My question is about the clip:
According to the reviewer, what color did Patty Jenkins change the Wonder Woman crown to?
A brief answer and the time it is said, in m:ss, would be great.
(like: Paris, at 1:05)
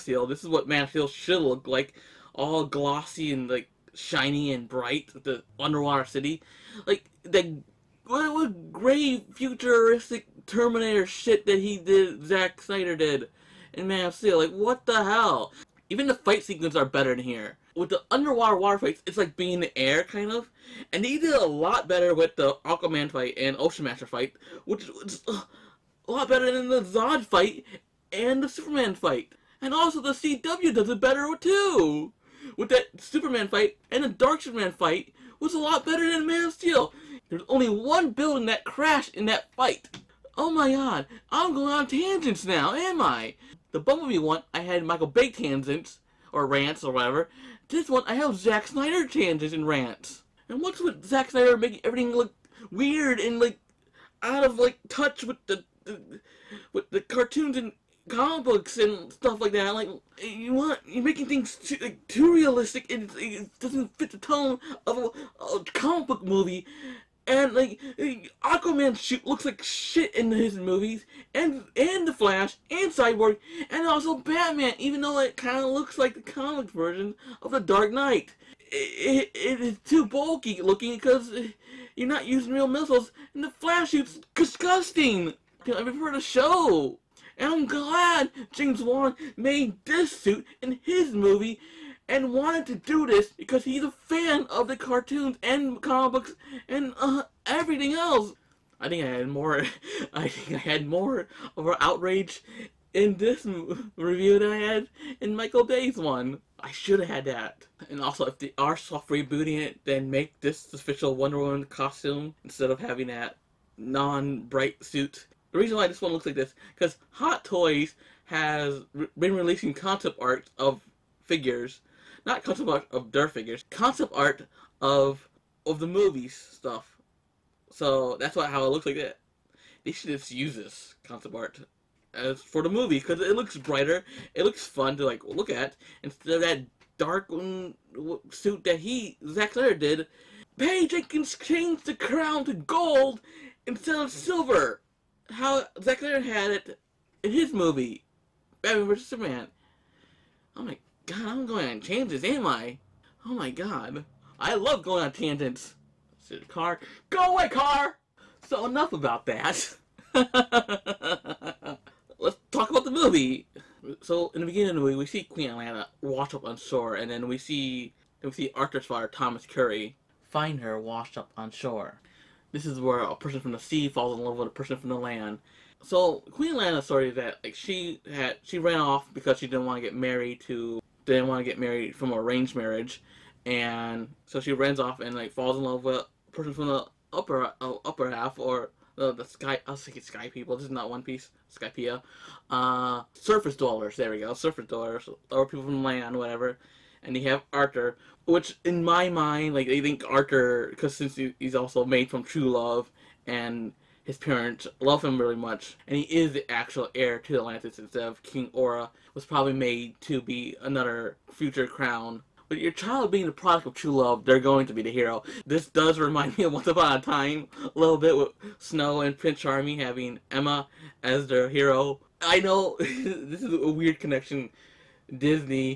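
Gold, at 2:22.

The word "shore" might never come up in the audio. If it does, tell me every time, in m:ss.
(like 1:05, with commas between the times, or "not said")
2:46, 2:51.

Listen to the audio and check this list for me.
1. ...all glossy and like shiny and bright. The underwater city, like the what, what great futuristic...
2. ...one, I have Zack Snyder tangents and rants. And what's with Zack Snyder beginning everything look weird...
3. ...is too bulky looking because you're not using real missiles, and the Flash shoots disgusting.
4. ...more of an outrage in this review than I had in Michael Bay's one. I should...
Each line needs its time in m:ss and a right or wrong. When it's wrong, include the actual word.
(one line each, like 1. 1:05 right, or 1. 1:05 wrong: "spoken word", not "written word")
1. 0:02 right
2. 0:47 wrong: "making", not "beginning"
3. 1:19 right
4. 1:40 right.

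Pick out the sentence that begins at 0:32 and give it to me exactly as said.
With that Superman fight and the Dark Superman fight was a lot better than Man of Steel.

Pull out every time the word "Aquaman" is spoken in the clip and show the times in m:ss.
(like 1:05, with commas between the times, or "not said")
0:22, 1:08.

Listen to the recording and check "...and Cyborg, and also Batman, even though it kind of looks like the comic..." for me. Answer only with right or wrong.
right.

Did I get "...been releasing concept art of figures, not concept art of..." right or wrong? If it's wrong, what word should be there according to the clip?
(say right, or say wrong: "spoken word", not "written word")
right.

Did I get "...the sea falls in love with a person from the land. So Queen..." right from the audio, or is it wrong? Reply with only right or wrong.
right.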